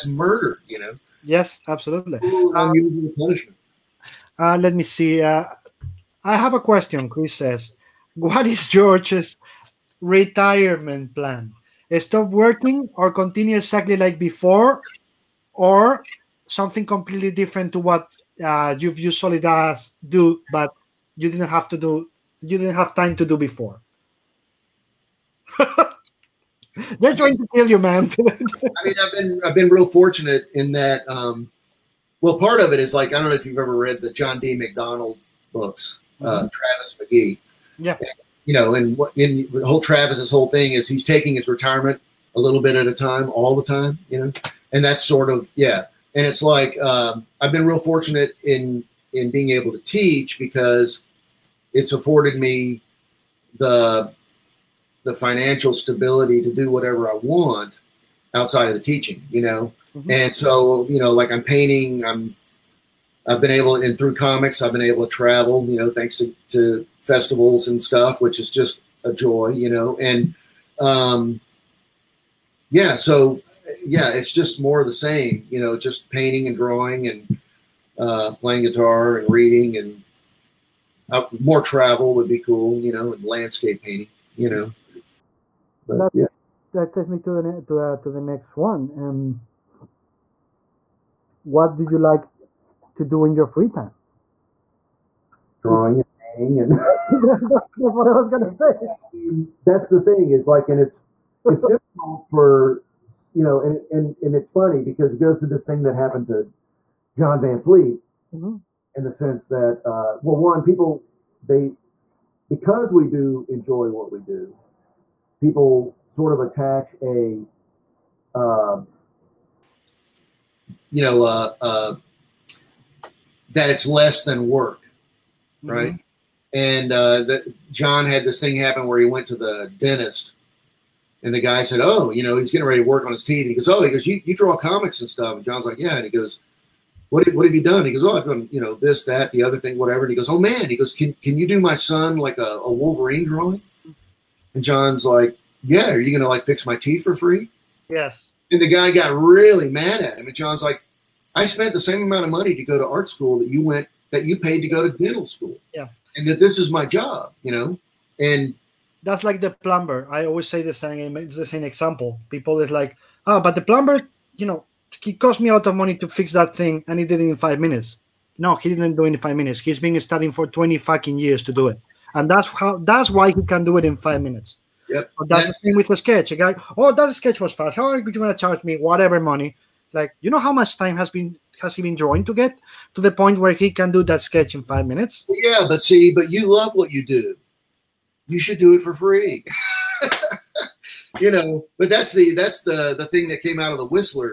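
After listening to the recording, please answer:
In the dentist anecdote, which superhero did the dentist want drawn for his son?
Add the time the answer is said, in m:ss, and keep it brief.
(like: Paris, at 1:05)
Wolverine, at 2:22.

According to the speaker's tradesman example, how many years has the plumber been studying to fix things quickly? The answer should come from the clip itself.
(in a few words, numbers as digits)
20.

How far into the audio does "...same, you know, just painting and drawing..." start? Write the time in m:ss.
1:14.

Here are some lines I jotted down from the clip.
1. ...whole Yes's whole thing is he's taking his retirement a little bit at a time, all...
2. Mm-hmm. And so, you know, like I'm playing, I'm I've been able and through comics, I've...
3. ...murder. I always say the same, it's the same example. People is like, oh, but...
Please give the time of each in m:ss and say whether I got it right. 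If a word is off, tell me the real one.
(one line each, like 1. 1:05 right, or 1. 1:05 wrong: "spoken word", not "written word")
1. 0:39 wrong: "Travis", not "Yes"
2. 0:59 wrong: "painting", not "playing"
3. 2:39 wrong: "plumber", not "murder".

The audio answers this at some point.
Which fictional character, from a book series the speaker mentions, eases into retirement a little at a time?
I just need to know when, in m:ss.
0:36.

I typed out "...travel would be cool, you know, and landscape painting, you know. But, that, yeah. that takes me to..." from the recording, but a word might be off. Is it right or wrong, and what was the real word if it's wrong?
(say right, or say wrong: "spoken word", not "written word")
right.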